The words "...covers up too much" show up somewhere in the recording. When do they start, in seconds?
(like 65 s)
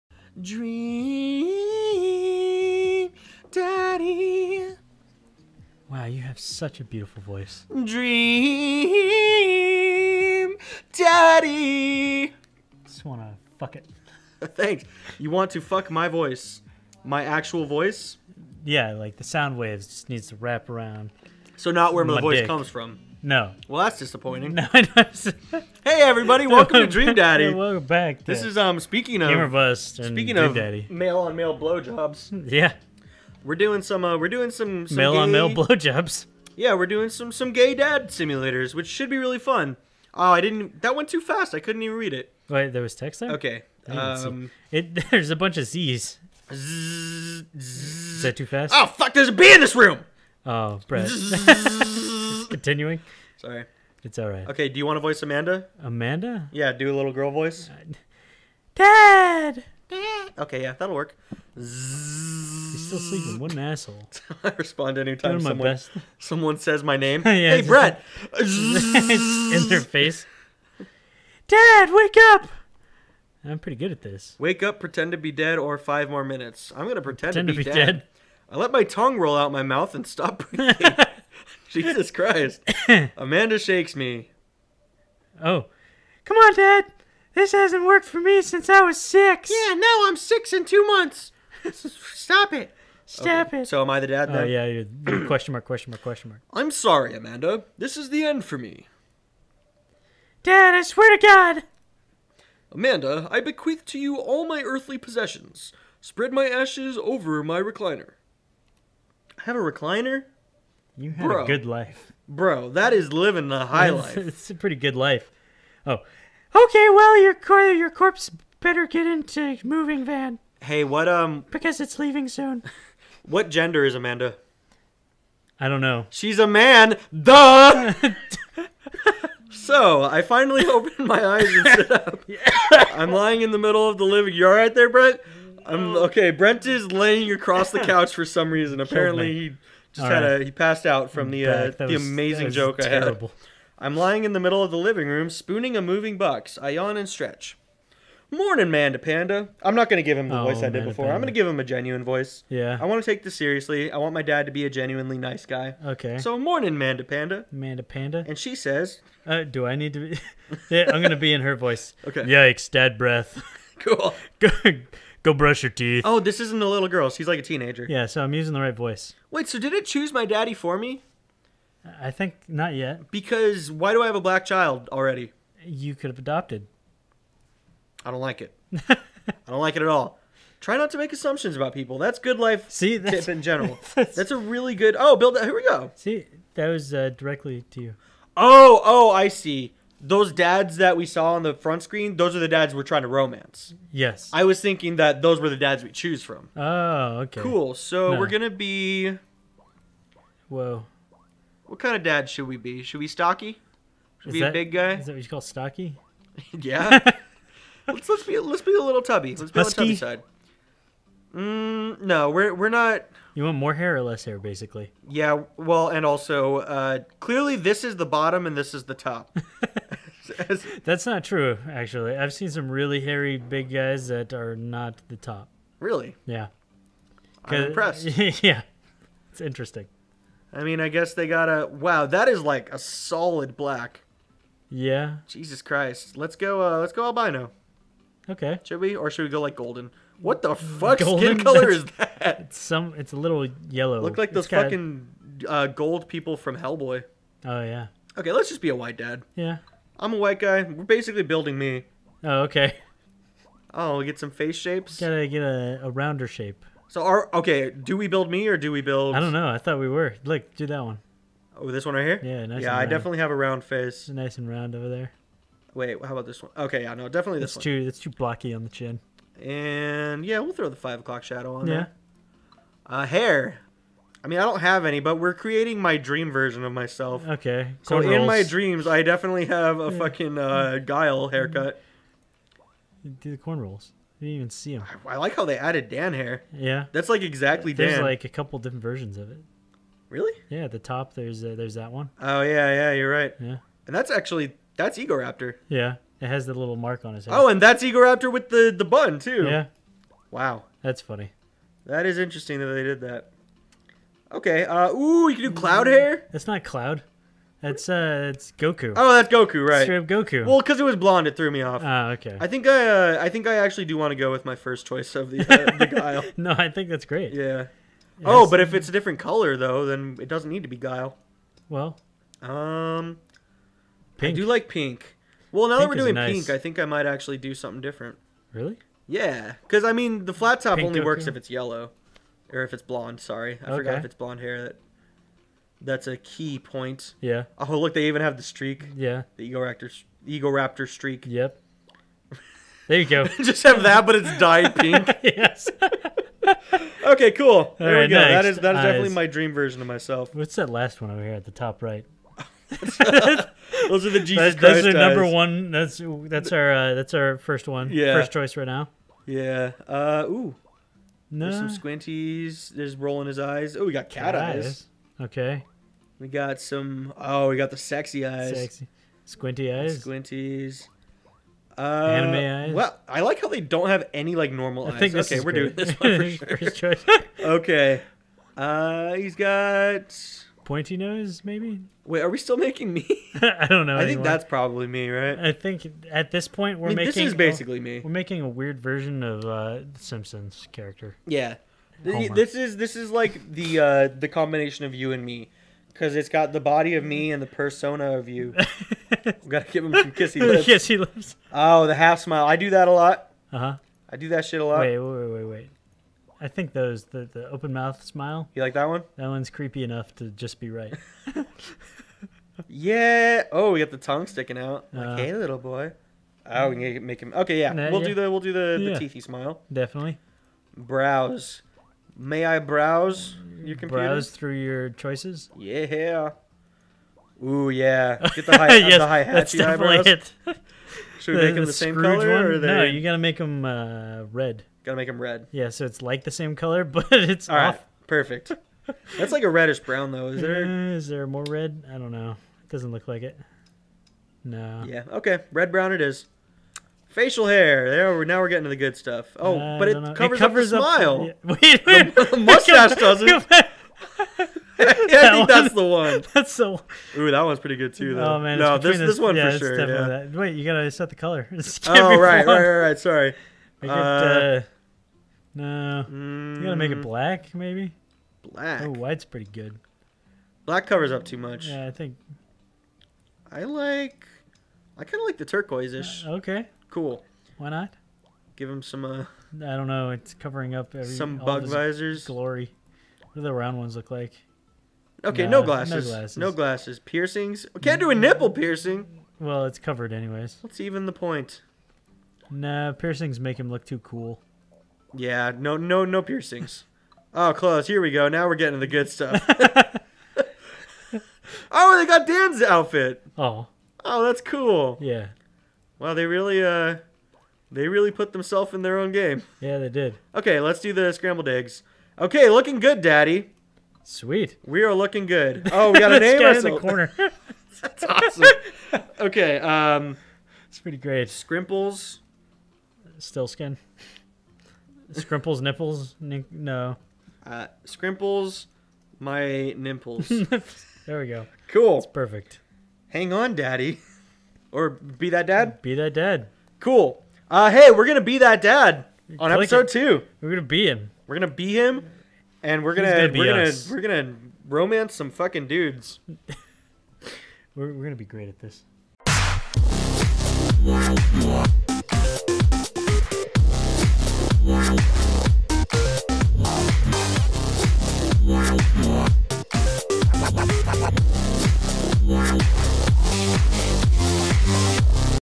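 470 s.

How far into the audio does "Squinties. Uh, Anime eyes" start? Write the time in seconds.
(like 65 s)
370 s.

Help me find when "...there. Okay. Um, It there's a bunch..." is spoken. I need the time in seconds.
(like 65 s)
43 s.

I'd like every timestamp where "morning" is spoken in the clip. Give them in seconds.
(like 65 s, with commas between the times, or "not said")
148 s, 156 s.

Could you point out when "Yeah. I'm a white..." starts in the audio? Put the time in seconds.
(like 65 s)
249 s.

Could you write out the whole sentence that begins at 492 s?
Nah, piercings make him look too cool.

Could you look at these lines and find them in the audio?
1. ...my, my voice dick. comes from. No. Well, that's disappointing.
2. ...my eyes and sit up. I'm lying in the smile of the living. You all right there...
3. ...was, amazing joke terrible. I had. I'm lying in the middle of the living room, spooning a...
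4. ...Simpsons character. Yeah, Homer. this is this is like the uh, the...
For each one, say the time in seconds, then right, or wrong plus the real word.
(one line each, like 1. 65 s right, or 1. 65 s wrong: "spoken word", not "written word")
1. 22 s right
2. 131 s wrong: "middle", not "smile"
3. 141 s right
4. 389 s right.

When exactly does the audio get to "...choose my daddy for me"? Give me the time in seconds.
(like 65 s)
169 s.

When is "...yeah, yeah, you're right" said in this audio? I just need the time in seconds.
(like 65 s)
292 s.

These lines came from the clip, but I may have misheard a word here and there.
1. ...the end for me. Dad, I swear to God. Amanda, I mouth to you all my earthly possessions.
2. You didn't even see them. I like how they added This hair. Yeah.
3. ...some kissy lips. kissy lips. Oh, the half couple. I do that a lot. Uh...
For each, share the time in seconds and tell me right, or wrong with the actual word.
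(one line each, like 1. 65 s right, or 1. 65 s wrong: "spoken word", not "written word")
1. 98 s wrong: "bequeath", not "mouth"
2. 284 s wrong: "Dan", not "This"
3. 399 s wrong: "smile", not "couple".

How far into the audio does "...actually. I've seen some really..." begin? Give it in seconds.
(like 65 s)
221 s.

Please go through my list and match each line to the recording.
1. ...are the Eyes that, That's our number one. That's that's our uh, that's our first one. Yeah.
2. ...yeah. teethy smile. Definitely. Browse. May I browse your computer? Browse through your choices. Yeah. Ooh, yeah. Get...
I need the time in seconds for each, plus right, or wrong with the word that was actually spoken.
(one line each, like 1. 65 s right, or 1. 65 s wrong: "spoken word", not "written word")
1. 354 s wrong: "Jesus", not "Eyes"
2. 418 s right.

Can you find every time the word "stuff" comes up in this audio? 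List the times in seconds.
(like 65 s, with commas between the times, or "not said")
448 s, 499 s.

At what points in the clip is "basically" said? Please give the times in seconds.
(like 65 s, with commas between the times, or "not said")
214 s, 250 s, 387 s.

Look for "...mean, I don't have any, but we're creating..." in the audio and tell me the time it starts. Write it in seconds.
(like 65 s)
274 s.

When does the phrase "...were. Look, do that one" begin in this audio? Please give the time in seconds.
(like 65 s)
259 s.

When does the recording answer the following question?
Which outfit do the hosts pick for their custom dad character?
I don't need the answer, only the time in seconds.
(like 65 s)
511 s.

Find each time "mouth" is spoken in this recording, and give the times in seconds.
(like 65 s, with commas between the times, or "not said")
79 s, 407 s.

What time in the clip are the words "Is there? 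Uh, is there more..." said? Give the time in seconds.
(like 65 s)
440 s.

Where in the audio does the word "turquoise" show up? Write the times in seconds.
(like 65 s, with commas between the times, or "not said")
475 s.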